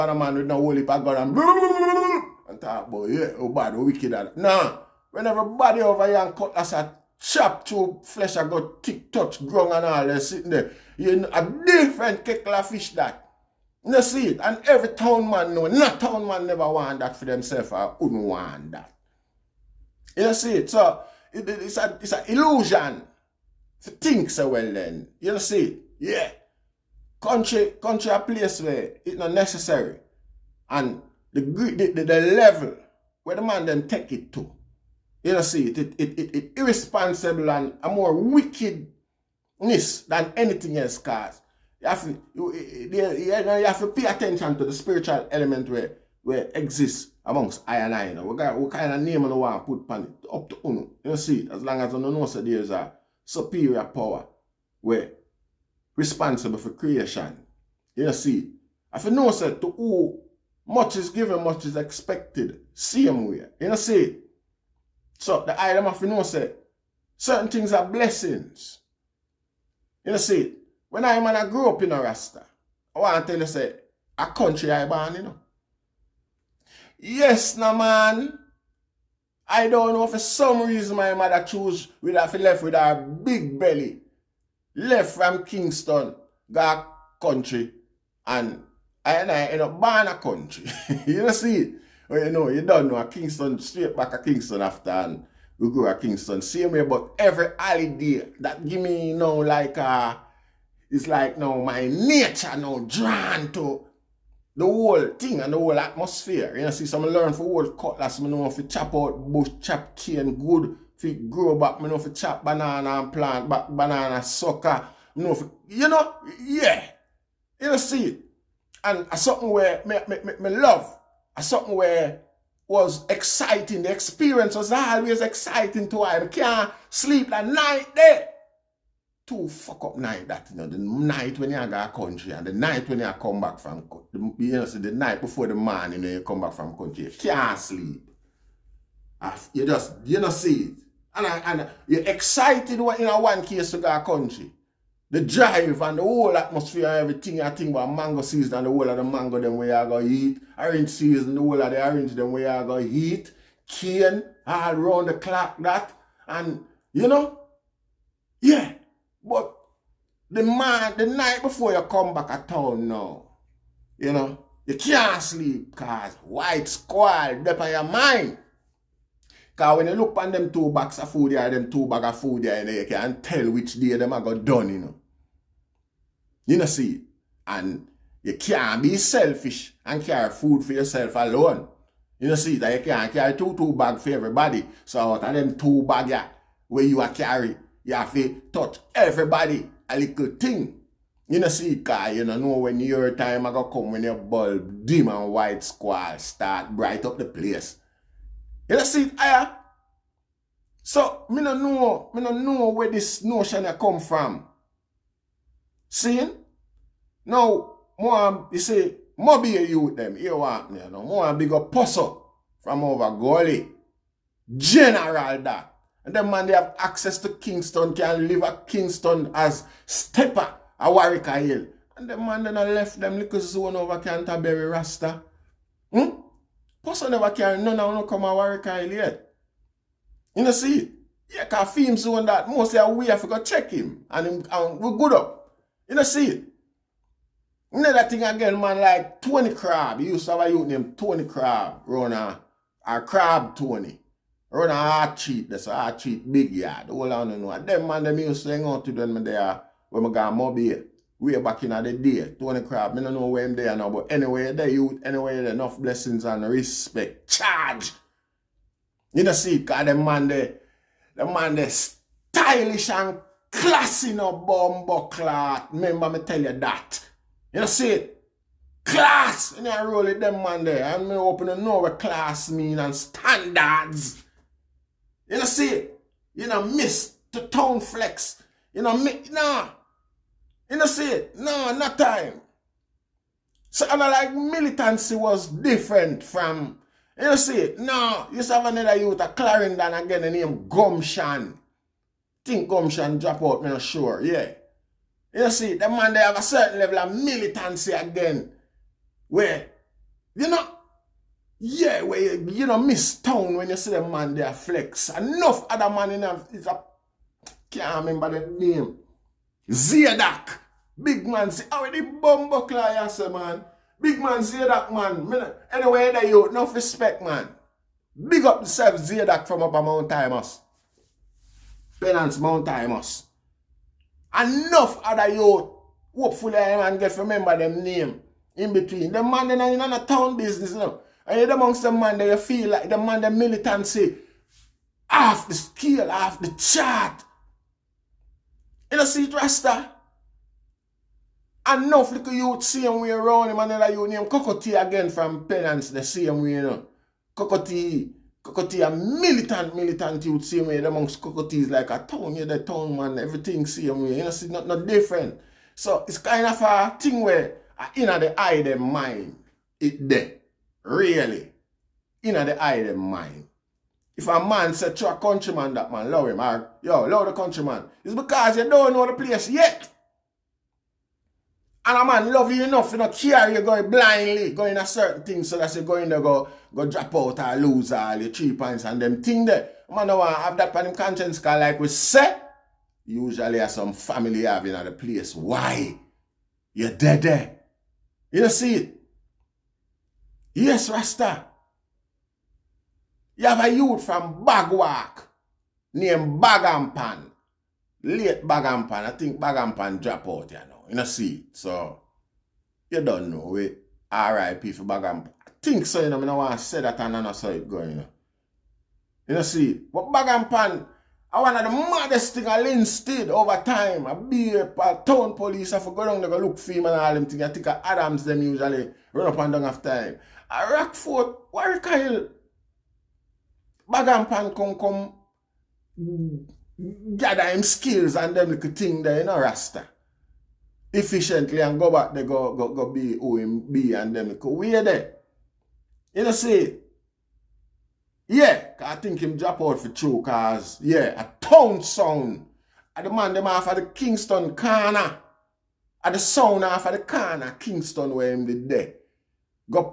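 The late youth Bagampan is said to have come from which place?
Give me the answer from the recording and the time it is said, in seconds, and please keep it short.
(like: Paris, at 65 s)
Bagwalk, at 394 s.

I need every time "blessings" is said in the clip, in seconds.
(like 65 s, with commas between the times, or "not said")
67 s, 255 s.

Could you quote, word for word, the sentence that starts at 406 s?
I don't want to say that and I know say it going, you know.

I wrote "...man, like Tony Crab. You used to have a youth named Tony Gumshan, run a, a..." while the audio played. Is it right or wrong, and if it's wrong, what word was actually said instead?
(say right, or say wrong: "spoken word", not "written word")
wrong: "Crab", not "Gumshan".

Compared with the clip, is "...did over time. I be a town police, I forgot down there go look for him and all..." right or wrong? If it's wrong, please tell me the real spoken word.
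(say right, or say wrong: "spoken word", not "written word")
right.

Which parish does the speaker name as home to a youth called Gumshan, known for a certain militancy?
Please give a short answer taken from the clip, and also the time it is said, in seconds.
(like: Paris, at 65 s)
Clarendon, at 289 s.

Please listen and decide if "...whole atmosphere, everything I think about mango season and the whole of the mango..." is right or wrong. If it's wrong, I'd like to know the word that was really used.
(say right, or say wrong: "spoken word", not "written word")
right.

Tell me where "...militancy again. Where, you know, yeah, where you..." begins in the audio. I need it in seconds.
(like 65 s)
297 s.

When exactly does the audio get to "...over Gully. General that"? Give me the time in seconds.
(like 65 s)
212 s.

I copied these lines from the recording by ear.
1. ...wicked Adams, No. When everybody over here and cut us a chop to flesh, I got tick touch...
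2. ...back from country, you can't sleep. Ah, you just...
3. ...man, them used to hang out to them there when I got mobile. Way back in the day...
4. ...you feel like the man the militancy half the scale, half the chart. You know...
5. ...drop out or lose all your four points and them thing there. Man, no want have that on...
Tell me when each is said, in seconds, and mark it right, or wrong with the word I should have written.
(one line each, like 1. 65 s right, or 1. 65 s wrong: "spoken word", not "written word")
1. 3 s wrong: "Nah", not "Adams"
2. 136 s right
3. 247 s right
4. 332 s right
5. 376 s wrong: "three", not "four".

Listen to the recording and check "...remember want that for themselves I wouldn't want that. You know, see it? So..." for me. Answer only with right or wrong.
wrong.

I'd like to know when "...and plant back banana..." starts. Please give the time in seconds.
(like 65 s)
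113 s.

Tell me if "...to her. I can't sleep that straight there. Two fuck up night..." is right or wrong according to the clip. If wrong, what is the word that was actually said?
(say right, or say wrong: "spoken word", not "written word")
wrong: "night", not "straight".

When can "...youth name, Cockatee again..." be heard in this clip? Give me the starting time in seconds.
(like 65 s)
343 s.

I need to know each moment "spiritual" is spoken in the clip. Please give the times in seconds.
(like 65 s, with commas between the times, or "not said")
44 s.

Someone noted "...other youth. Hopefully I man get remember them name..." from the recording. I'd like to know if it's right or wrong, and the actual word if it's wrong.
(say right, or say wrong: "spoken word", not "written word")
right.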